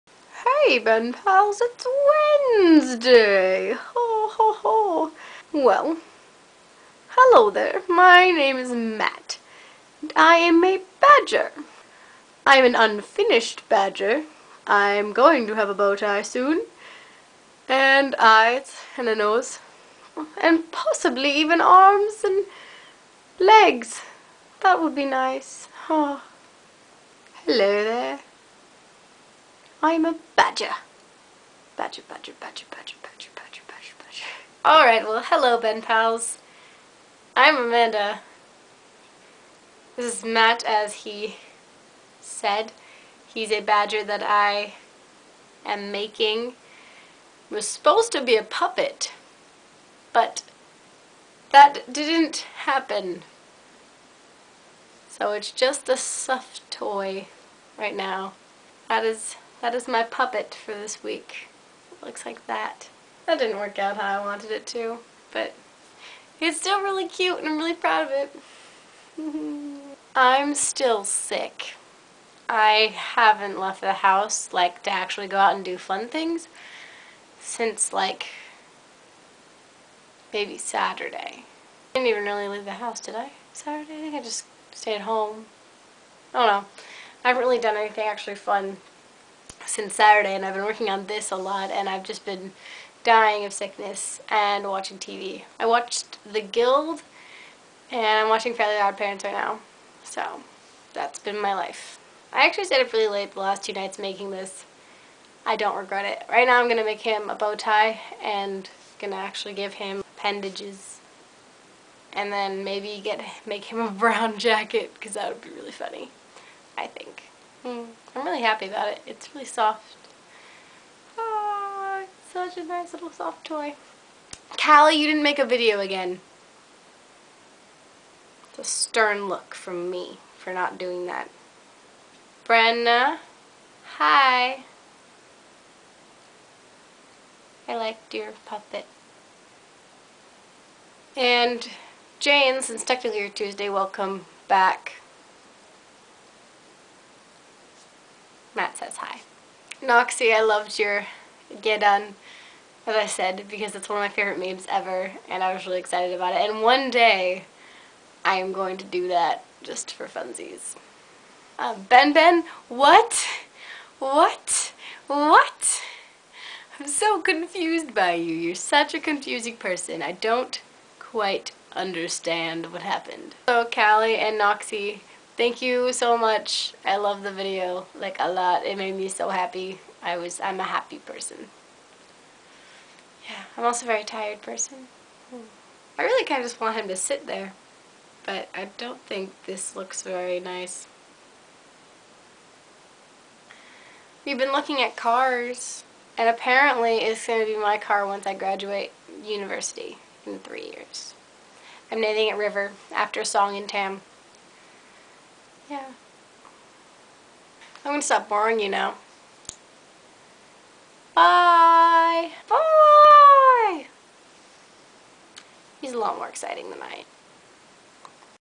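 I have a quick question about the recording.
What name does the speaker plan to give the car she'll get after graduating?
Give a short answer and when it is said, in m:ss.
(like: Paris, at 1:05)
River, at 3:22.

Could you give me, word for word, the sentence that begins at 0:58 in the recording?
That is that is my puppet for this week.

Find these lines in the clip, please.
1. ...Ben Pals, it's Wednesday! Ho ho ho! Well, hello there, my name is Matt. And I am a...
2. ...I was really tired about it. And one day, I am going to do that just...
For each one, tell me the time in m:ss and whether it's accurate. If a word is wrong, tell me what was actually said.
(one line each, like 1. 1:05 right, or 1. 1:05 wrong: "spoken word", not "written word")
1. 0:00 right
2. 2:35 wrong: "excited", not "tired".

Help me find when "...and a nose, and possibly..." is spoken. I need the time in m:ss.
0:18.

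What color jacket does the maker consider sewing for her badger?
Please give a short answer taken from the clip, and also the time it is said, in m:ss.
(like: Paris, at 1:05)
Brown, at 1:53.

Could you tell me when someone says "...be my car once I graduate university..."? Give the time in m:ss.
3:17.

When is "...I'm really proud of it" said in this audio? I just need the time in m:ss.
1:07.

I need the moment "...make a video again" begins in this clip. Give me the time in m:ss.
2:05.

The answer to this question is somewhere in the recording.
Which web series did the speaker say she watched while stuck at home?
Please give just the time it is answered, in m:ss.
1:36.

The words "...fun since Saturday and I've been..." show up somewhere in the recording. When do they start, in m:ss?
1:28.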